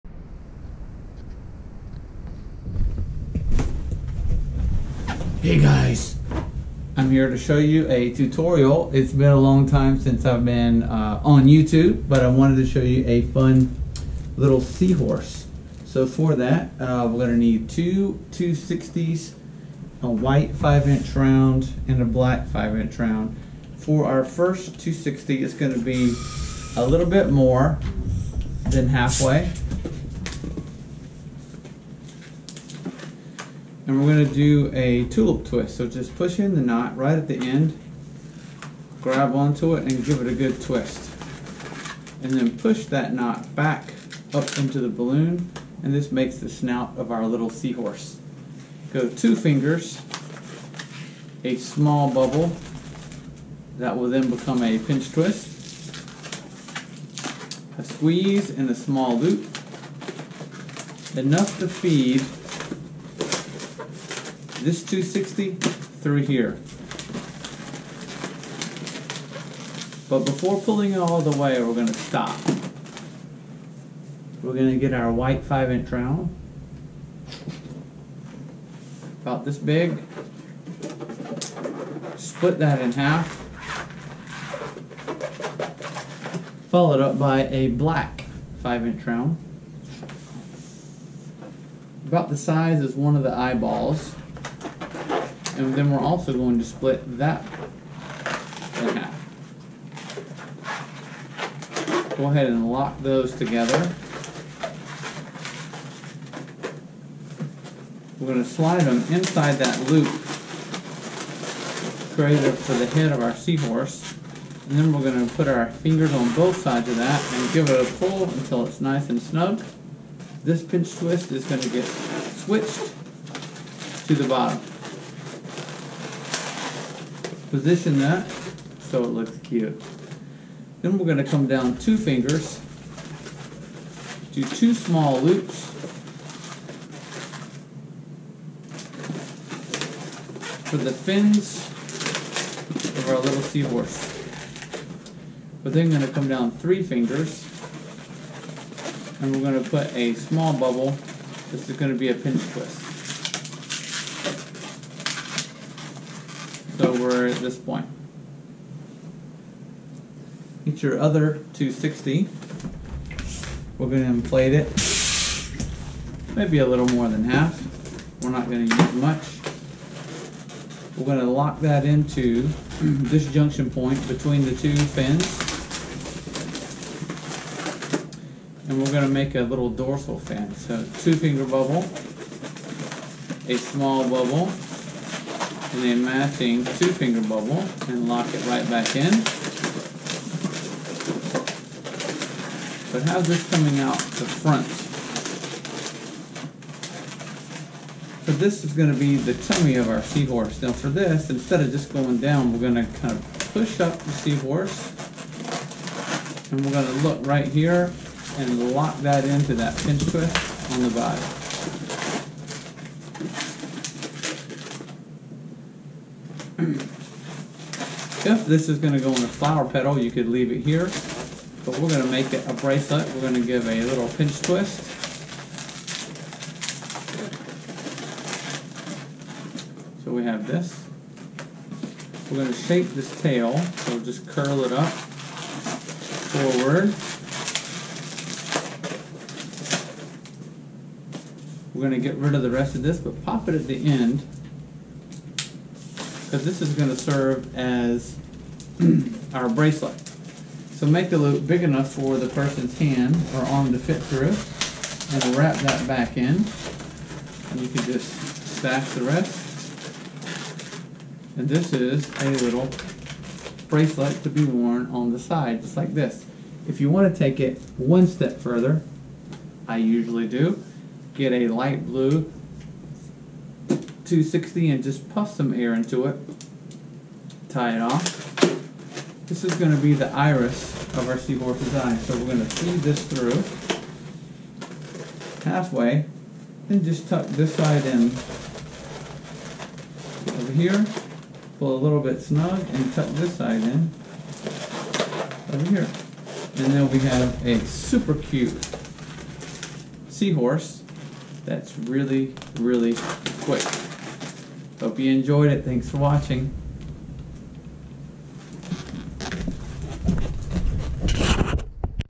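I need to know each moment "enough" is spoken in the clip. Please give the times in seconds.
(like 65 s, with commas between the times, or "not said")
61 s, 251 s.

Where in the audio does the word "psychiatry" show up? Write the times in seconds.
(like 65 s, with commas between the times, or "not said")
not said.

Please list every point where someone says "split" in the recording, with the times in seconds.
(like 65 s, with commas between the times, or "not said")
82 s, 96 s.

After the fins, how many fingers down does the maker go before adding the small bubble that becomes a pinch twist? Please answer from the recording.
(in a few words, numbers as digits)
3.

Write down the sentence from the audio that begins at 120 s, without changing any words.
This pinch twist is going to get switched to the bottom position that so it looks cute.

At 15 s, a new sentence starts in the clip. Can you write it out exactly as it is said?
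So for that, uh, we're gonna need two 260s, a white five inch round, and a black five inch round.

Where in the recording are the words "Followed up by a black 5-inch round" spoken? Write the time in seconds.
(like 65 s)
86 s.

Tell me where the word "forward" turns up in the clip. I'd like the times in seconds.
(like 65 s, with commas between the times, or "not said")
234 s.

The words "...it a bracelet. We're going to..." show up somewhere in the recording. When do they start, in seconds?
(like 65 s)
222 s.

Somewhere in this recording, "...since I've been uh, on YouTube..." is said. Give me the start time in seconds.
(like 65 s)
9 s.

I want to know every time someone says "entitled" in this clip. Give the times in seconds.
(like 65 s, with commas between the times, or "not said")
not said.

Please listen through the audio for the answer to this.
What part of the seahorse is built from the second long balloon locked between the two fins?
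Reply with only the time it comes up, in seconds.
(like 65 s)
179 s.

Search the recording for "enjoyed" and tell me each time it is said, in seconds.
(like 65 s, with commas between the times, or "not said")
305 s.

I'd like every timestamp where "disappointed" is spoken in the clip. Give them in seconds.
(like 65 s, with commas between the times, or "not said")
not said.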